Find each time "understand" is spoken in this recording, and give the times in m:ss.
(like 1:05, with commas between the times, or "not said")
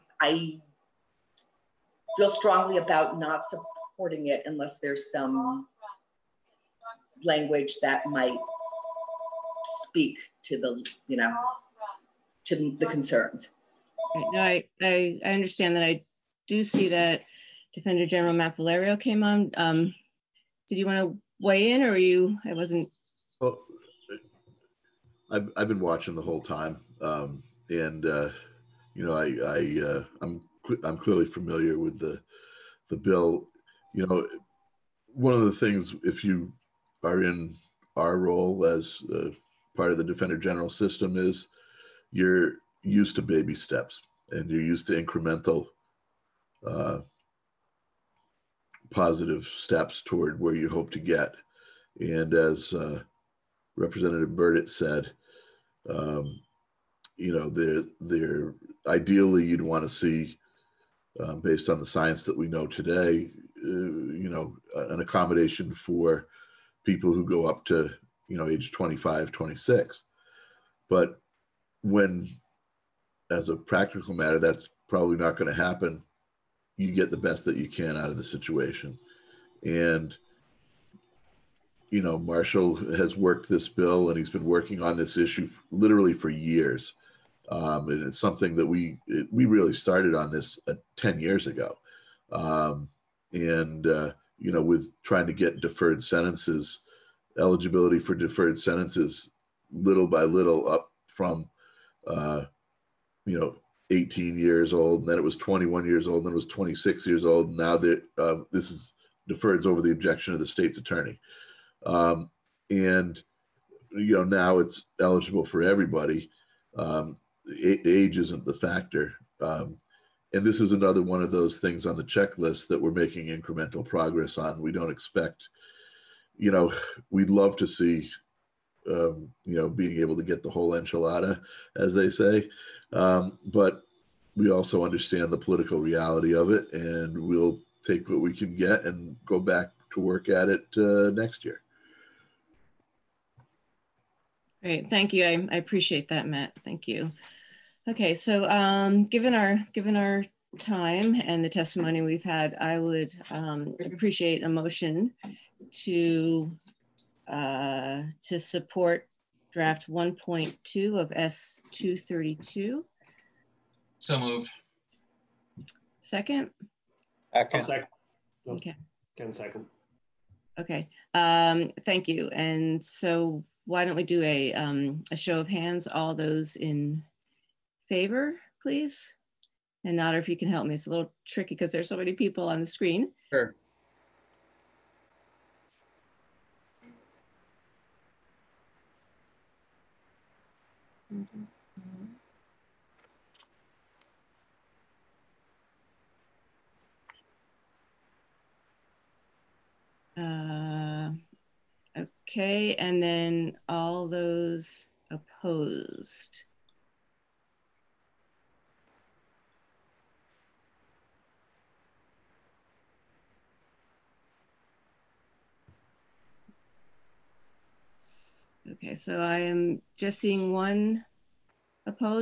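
0:15, 2:14.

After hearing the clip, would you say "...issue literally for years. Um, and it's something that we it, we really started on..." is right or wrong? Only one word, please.
right.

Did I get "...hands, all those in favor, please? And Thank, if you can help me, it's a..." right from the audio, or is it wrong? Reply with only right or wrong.
wrong.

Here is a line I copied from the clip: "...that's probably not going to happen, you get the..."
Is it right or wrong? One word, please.
right.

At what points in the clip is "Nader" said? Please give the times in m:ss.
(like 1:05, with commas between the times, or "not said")
2:59.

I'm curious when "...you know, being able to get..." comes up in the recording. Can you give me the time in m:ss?
2:09.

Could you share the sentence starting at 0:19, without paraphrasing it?
Um, did you want to weigh in or are you, I wasn't.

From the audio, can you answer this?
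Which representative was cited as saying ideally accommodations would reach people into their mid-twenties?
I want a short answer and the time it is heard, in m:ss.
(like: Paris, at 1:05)
Burditt, at 0:54.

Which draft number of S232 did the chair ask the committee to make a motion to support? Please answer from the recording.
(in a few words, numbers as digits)
1.2.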